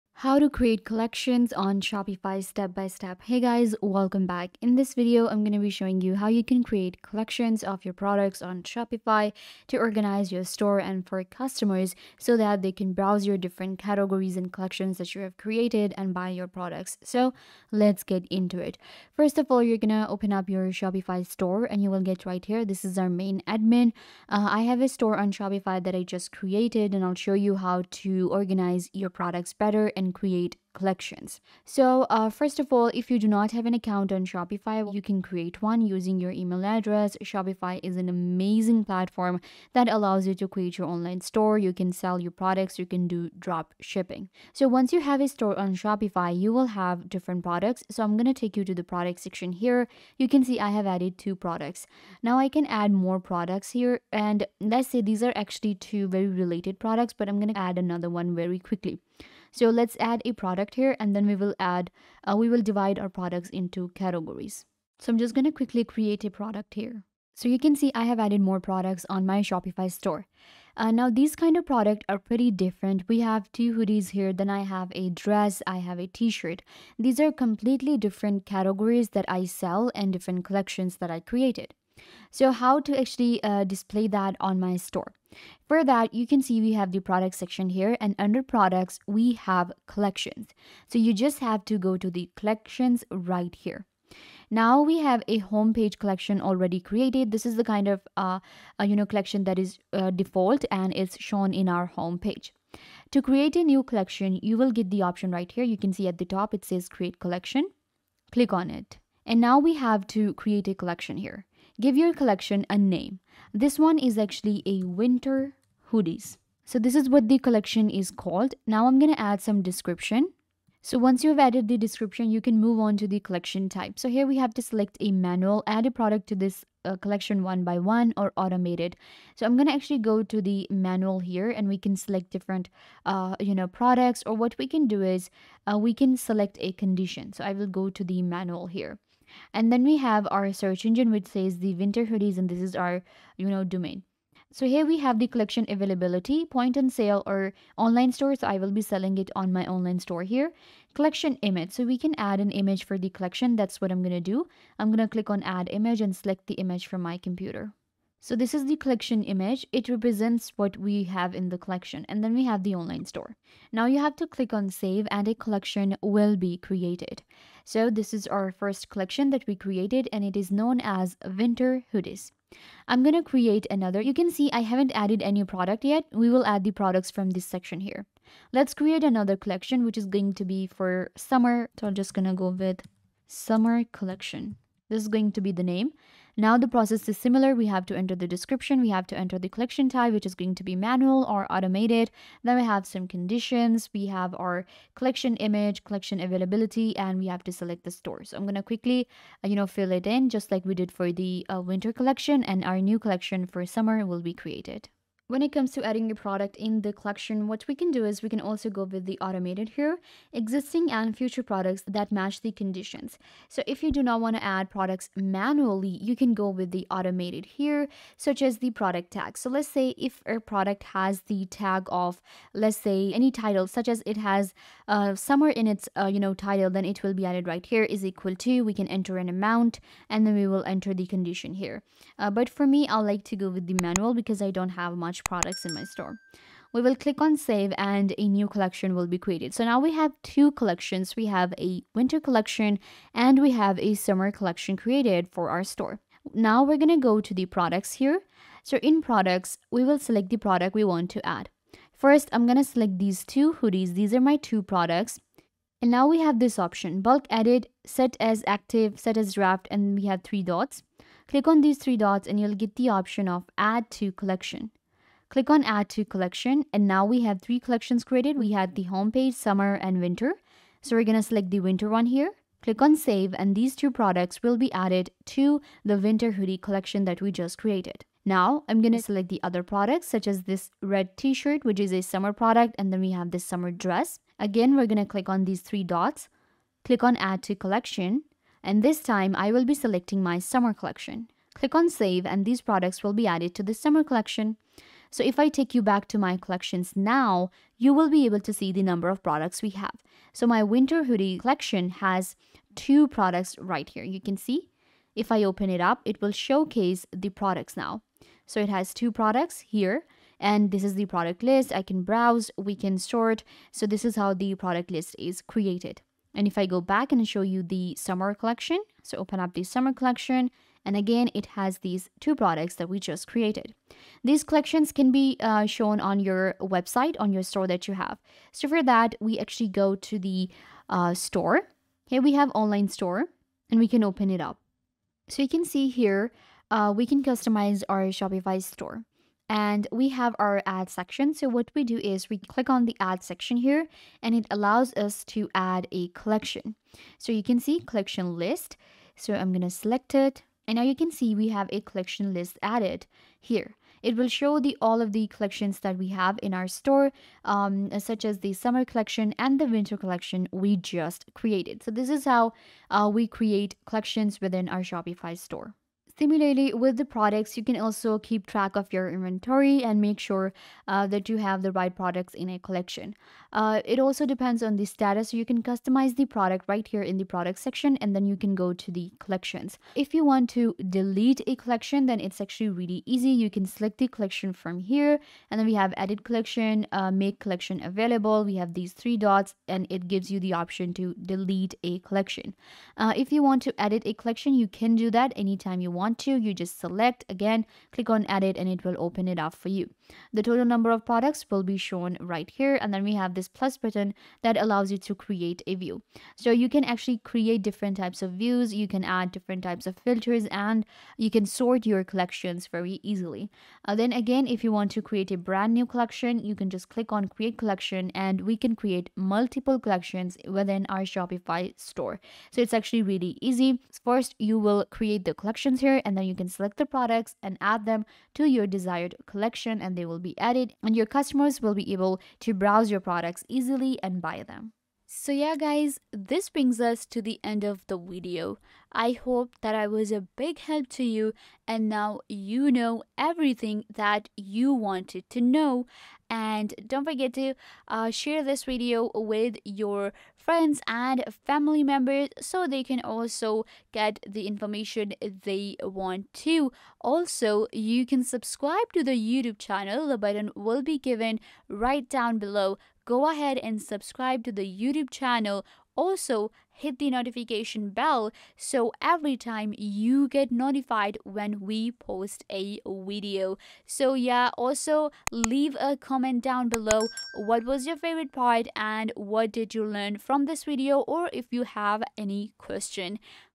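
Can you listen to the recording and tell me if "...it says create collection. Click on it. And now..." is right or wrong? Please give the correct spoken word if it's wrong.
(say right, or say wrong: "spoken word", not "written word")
right.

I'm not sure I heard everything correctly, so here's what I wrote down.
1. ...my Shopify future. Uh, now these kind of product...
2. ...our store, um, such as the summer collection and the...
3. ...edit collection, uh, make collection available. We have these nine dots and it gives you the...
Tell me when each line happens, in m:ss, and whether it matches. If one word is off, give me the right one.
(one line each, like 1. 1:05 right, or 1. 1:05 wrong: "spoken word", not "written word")
1. 1:09 wrong: "store", not "future"
2. 5:56 right
3. 6:25 wrong: "three", not "nine".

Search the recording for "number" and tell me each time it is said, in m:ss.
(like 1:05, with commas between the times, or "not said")
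4:58, 6:40.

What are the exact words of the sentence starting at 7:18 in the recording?
I hope that I was a big help to you and now you know everything that you wanted to know.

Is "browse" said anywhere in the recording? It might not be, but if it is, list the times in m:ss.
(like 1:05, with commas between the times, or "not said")
0:12, 5:12, 7:12.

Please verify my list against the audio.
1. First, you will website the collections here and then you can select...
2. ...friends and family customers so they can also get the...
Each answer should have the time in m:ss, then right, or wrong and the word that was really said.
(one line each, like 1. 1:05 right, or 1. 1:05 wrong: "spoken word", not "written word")
1. 7:04 wrong: "create", not "website"
2. 7:30 wrong: "members", not "customers".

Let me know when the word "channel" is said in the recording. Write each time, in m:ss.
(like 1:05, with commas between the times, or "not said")
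7:39, 7:45.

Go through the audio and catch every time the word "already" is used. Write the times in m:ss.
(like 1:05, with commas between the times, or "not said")
1:36.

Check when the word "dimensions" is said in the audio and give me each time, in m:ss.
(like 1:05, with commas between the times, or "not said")
not said.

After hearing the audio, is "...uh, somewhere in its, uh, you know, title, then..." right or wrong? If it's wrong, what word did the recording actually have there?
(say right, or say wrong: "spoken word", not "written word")
right.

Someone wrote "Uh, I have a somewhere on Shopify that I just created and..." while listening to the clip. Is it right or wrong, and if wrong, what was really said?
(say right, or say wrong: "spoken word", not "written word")
wrong: "store", not "somewhere".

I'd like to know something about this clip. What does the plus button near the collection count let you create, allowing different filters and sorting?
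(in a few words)
A view.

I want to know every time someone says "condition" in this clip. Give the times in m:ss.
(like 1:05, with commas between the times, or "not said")
2:16, 3:13, 3:32, 3:51.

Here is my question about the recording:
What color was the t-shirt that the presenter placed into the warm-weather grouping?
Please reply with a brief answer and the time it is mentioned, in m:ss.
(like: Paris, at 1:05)
Red, at 4:40.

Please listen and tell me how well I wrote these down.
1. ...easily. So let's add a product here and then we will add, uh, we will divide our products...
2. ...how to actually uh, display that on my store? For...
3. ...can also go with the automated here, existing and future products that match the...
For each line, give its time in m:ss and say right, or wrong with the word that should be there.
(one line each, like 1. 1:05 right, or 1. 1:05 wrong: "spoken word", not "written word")
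1. 0:58 wrong: "quickly", not "easily"
2. 1:22 right
3. 3:28 right.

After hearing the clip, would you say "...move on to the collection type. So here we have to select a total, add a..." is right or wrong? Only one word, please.
wrong.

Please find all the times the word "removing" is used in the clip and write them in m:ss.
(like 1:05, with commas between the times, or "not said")
not said.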